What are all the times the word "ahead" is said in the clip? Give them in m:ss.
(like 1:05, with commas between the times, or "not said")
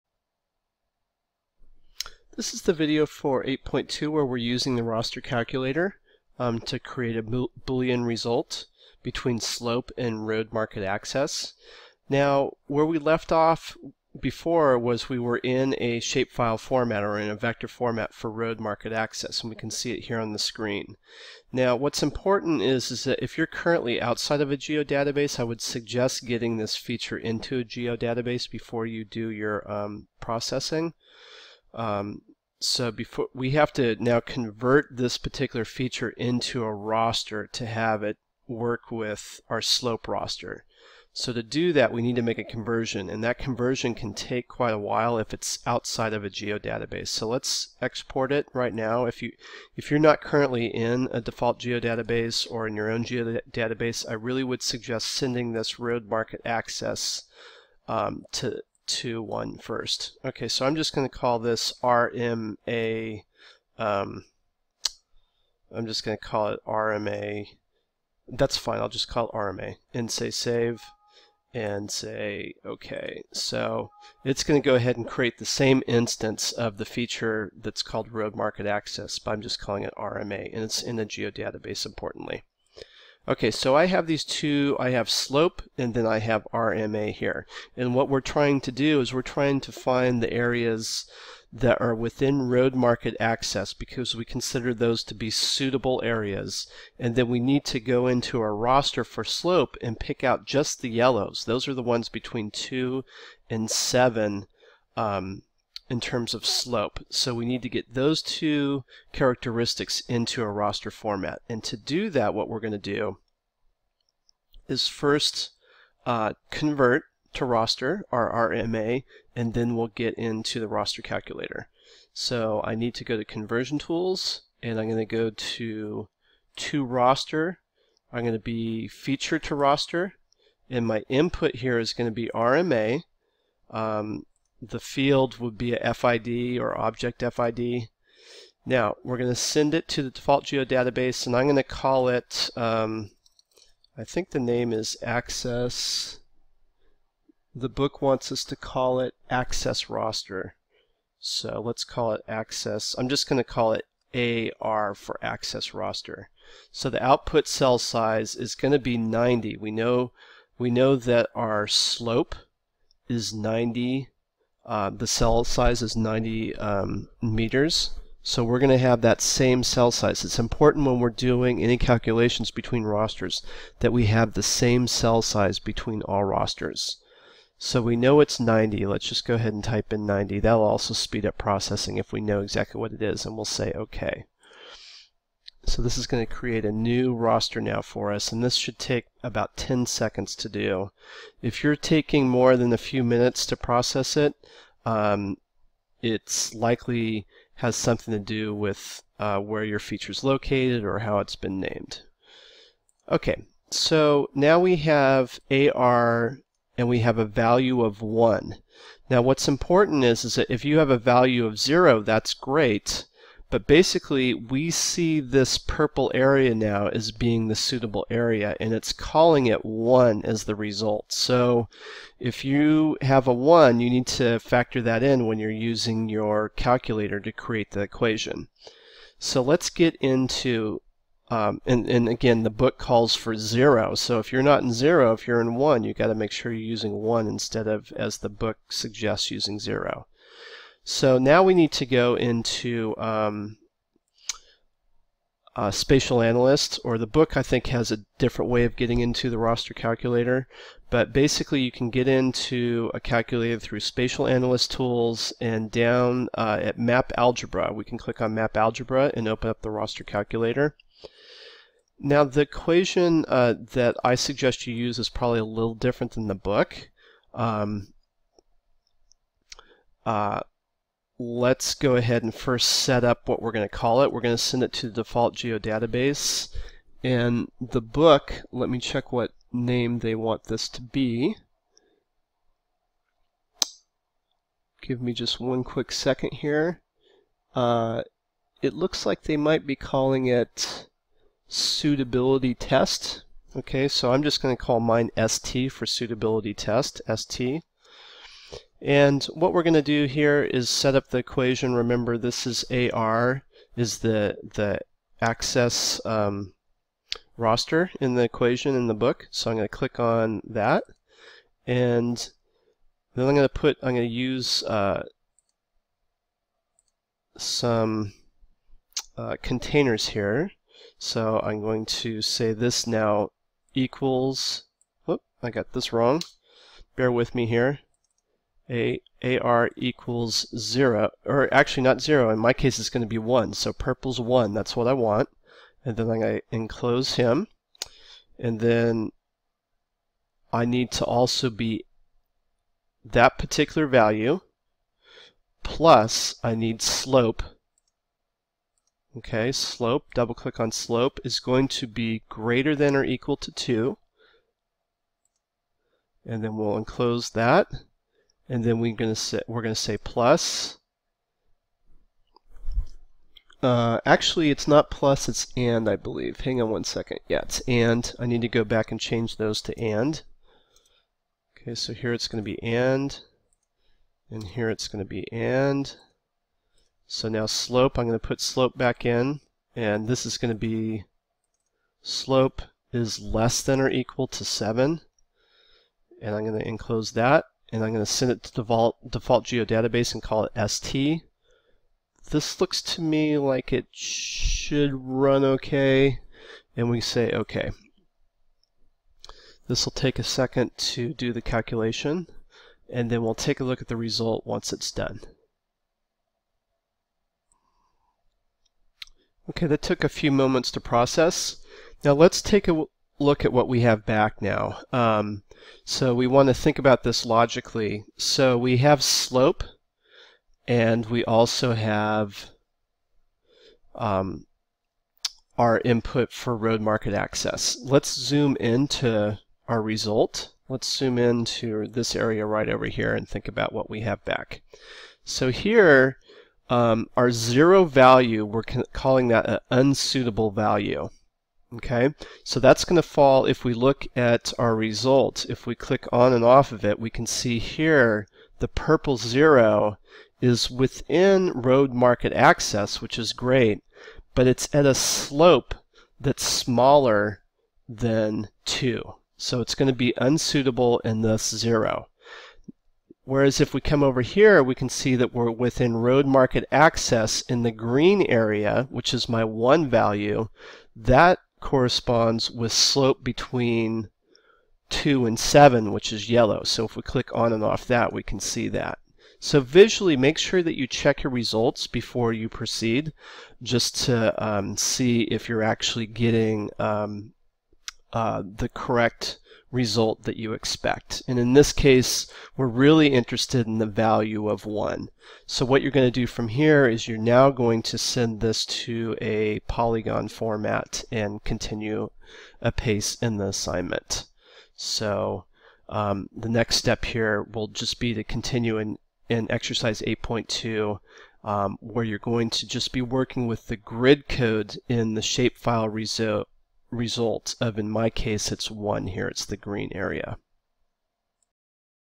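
1:14, 2:59, 4:31.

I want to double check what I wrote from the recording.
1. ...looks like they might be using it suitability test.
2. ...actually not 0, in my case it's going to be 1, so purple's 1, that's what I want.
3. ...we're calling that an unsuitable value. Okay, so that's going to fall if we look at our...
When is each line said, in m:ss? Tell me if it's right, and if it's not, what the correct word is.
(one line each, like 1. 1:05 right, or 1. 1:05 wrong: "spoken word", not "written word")
1. 4:48 wrong: "calling", not "using"
2. 5:31 right
3. 7:18 right.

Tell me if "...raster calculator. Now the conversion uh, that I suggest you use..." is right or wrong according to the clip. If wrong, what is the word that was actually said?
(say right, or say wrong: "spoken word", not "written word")
wrong: "equation", not "conversion".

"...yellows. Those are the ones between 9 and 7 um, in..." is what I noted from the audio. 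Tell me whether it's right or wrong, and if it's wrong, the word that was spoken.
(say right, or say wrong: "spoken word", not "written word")
wrong: "2", not "9".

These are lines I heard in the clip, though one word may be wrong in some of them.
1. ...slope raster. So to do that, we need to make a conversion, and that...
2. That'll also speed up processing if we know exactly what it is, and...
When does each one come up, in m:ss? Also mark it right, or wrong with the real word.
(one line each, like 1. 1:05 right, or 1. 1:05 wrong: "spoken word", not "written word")
1. 0:39 right
2. 3:00 right.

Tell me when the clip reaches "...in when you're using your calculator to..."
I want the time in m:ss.
3:45.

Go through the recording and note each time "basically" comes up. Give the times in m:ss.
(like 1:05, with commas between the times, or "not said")
3:33, 4:11.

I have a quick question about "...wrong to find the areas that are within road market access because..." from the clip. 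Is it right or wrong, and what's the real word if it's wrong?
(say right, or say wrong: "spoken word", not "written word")
wrong: "trying", not "wrong".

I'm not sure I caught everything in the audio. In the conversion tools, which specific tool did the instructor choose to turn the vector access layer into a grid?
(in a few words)
Feature to raster.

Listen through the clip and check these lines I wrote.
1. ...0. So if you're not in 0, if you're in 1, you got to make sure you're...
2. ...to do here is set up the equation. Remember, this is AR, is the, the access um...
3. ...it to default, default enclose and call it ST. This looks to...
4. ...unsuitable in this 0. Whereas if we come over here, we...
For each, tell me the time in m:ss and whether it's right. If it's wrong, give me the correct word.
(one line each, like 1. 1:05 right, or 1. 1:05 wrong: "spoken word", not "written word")
1. 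3:53 right
2. 4:59 right
3. 6:28 wrong: "geodatabase", not "enclose"
4. 7:40 right.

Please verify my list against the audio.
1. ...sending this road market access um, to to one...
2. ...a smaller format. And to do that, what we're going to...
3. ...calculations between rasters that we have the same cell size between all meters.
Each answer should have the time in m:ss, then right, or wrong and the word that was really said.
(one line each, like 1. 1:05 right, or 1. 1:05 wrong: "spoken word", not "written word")
1. 0:55 right
2. 1:50 wrong: "raster", not "smaller"
3. 2:51 wrong: "rasters", not "meters".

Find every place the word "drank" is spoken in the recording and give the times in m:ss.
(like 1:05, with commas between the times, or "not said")
not said.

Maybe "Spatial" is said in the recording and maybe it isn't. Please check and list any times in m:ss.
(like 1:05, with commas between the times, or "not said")
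4:05, 4:13.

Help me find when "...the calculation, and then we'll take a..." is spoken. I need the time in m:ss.
6:41.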